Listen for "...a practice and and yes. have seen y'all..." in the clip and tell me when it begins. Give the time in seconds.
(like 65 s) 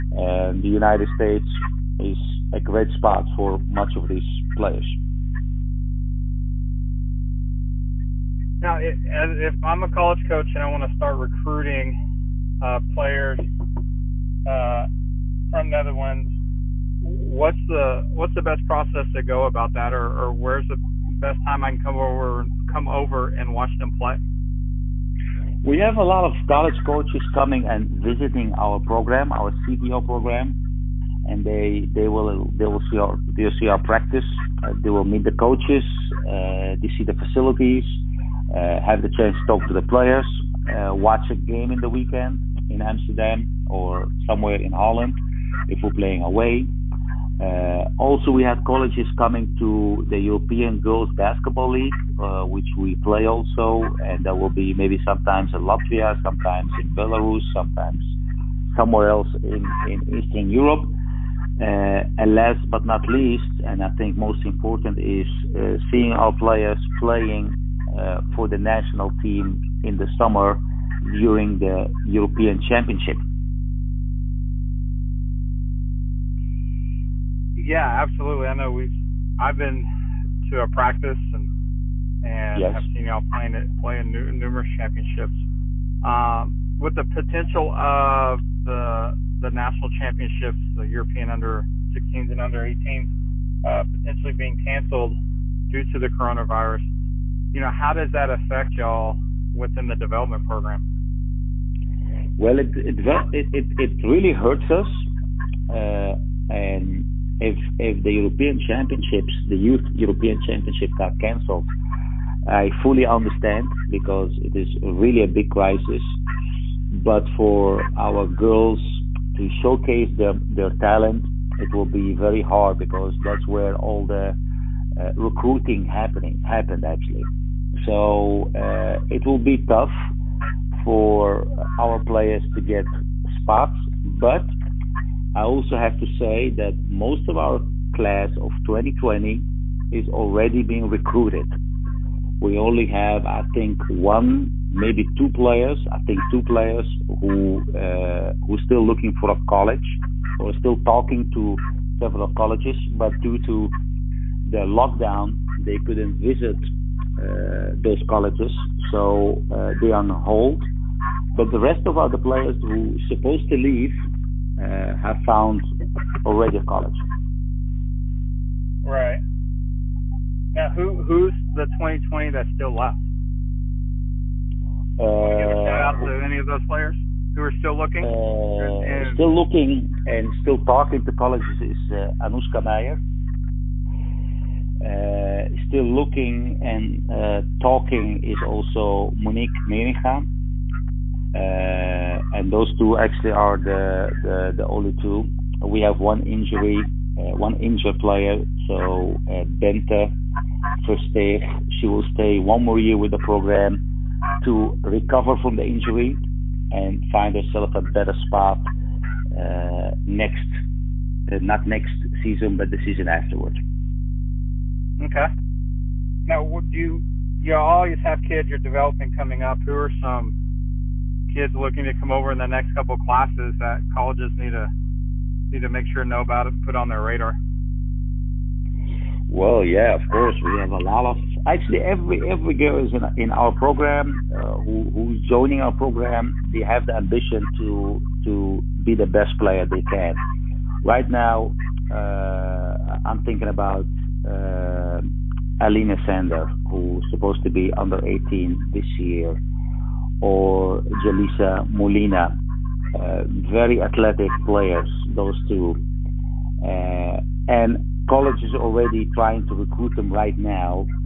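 80 s.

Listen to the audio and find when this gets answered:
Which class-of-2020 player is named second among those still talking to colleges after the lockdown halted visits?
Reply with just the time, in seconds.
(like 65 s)
189 s.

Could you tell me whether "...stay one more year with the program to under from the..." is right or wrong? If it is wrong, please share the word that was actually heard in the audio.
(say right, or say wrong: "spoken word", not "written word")
wrong: "recover", not "under".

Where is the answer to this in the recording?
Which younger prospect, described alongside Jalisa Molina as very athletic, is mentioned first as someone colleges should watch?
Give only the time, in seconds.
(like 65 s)
245 s.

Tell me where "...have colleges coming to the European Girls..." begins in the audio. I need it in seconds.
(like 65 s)
48 s.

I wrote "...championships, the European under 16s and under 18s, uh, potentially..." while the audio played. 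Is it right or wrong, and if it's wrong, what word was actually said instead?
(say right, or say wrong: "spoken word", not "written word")
right.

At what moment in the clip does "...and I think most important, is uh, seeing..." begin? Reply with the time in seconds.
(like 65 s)
63 s.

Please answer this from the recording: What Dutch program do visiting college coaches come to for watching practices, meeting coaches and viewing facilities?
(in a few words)
CDO.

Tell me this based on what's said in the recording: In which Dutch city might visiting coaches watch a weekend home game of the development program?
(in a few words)
Amsterdam.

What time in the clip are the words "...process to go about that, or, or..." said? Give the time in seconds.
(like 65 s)
18 s.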